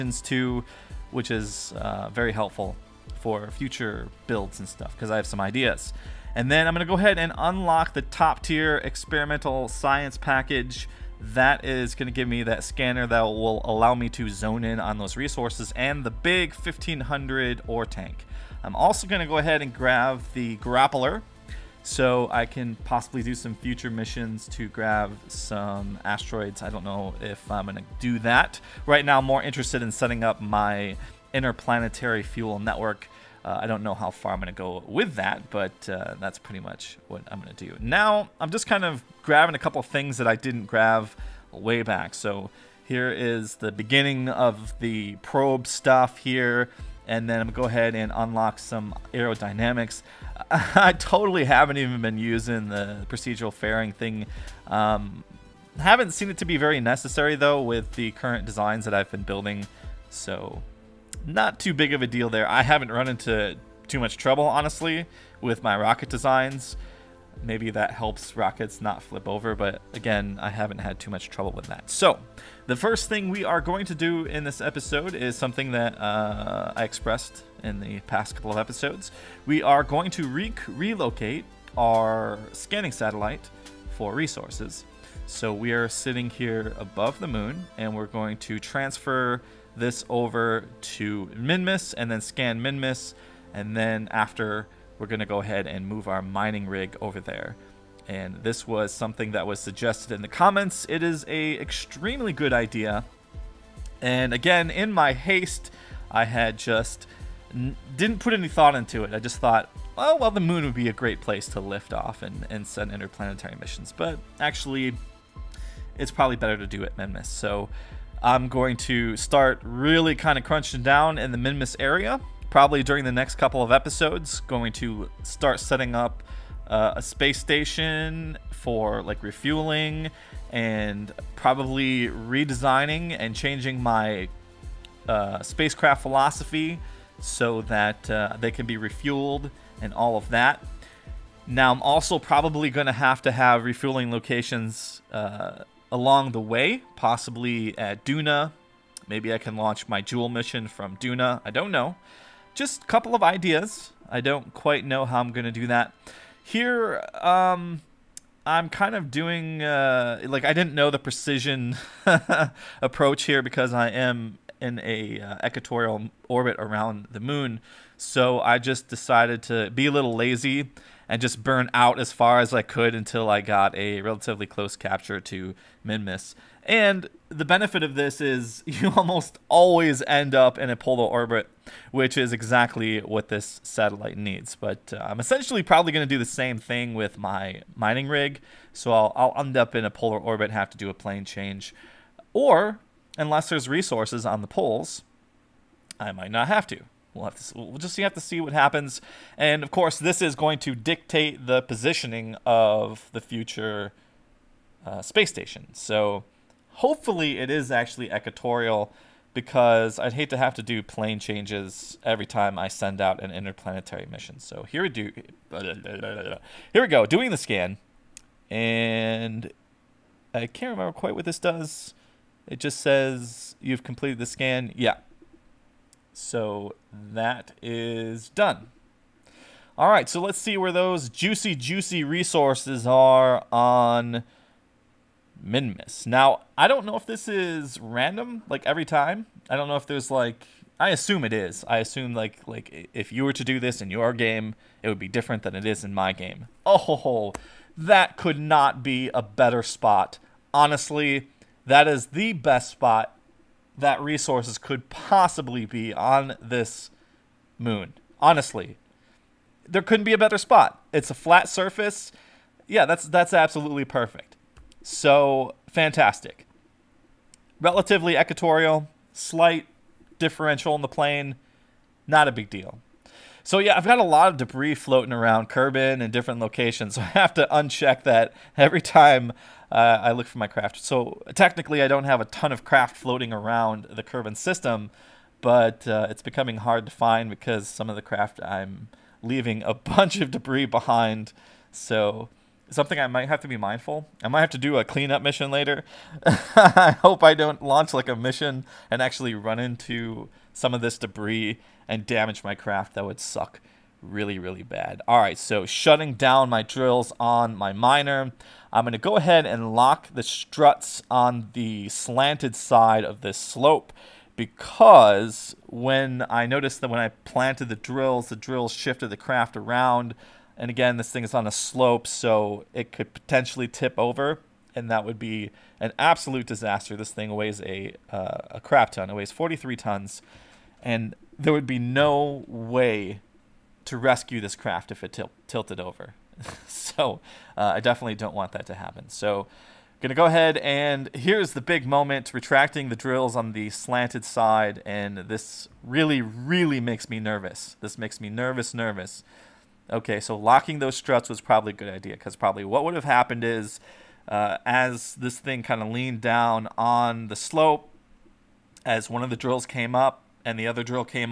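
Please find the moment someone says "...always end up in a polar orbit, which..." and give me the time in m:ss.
2:59.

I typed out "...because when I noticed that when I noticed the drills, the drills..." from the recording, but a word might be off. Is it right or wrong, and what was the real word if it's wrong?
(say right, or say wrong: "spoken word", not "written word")
wrong: "planted", not "noticed".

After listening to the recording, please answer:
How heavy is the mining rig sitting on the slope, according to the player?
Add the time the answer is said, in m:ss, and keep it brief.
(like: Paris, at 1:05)
43 tons, at 5:29.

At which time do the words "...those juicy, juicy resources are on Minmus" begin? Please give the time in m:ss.
3:50.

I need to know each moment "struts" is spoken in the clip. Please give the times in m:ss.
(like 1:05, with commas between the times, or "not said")
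5:10, 5:50.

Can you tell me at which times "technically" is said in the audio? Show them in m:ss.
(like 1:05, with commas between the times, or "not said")
4:41.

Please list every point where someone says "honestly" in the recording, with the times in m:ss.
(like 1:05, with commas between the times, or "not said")
1:04, 4:10, 4:18.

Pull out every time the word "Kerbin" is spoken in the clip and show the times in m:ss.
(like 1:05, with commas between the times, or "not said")
4:35, 4:44.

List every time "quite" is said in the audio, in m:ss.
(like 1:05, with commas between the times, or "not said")
2:34, 3:40.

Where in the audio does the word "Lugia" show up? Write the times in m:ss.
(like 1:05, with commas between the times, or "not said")
not said.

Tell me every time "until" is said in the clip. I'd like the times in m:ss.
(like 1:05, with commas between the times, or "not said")
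2:52.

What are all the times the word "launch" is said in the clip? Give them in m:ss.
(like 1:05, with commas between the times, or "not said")
2:29, 4:57.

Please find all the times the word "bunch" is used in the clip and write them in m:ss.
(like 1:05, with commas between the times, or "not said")
4:49.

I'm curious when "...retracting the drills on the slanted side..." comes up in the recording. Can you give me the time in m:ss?
5:42.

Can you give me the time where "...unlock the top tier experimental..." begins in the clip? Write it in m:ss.
0:07.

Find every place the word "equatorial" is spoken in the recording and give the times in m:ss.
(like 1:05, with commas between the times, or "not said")
2:45, 3:28, 4:28.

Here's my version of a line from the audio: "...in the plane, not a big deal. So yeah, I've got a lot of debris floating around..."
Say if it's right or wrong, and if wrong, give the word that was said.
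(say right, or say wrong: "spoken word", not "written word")
right.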